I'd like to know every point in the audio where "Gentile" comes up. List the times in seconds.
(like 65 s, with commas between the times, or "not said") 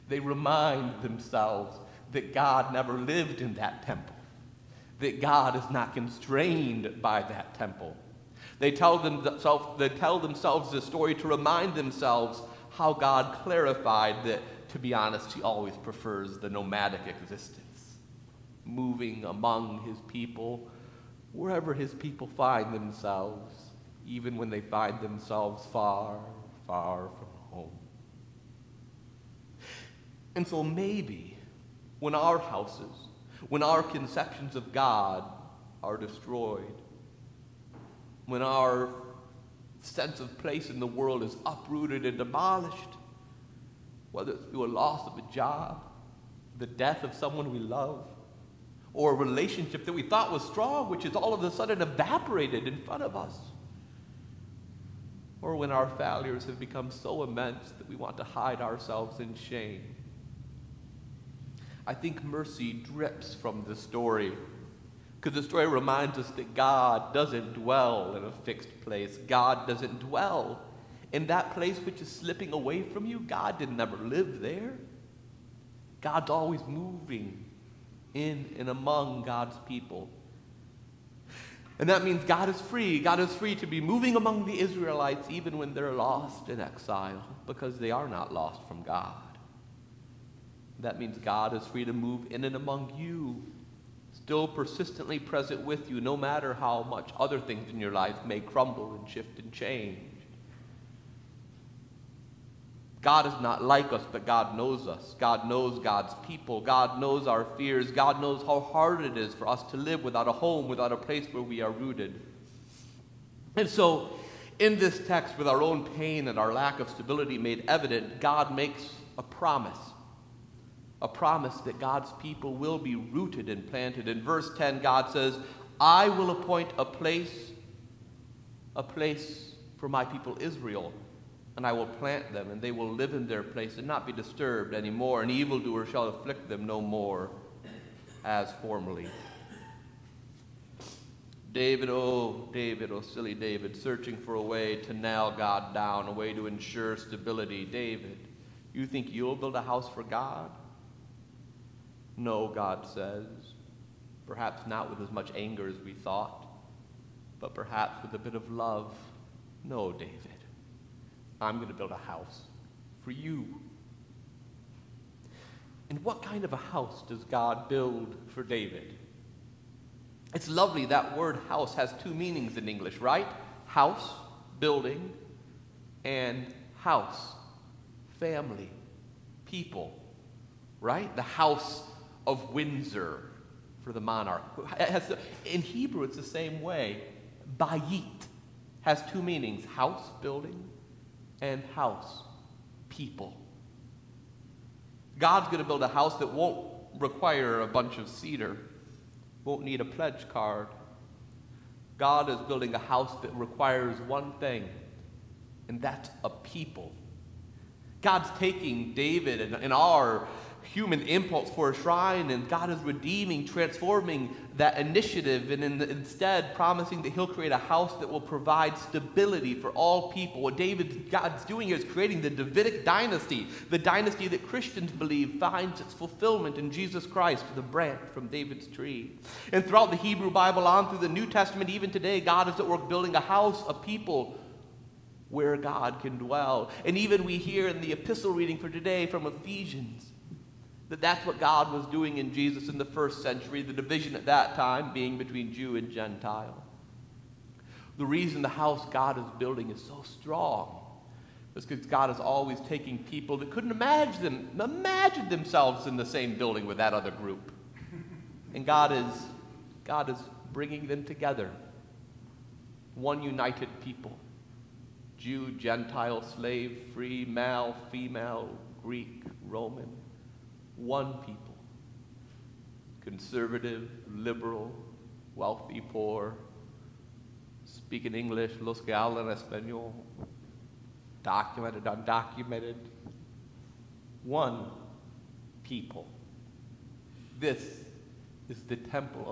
245 s, 265 s.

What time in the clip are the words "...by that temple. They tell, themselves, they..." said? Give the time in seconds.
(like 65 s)
7 s.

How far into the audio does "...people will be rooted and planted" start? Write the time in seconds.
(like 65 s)
122 s.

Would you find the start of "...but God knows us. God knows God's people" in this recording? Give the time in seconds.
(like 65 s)
104 s.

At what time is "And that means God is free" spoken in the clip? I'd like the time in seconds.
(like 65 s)
81 s.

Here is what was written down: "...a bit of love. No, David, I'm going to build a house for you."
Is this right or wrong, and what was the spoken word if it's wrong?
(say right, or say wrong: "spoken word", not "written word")
right.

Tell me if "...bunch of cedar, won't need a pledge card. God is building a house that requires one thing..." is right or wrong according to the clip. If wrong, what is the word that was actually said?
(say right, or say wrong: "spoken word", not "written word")
right.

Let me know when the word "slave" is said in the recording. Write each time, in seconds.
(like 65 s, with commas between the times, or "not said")
266 s.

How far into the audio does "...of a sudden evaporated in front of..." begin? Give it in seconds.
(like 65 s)
51 s.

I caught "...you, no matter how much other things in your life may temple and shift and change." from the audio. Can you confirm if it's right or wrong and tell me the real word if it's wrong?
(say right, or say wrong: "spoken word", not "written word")
wrong: "crumble", not "temple".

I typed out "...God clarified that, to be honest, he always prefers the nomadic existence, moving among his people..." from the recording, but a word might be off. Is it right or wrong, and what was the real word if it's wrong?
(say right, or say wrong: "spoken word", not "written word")
right.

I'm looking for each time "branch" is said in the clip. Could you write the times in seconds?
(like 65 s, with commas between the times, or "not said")
227 s.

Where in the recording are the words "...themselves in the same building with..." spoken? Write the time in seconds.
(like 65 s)
255 s.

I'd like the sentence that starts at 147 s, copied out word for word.
David, you think you'll build a house for God?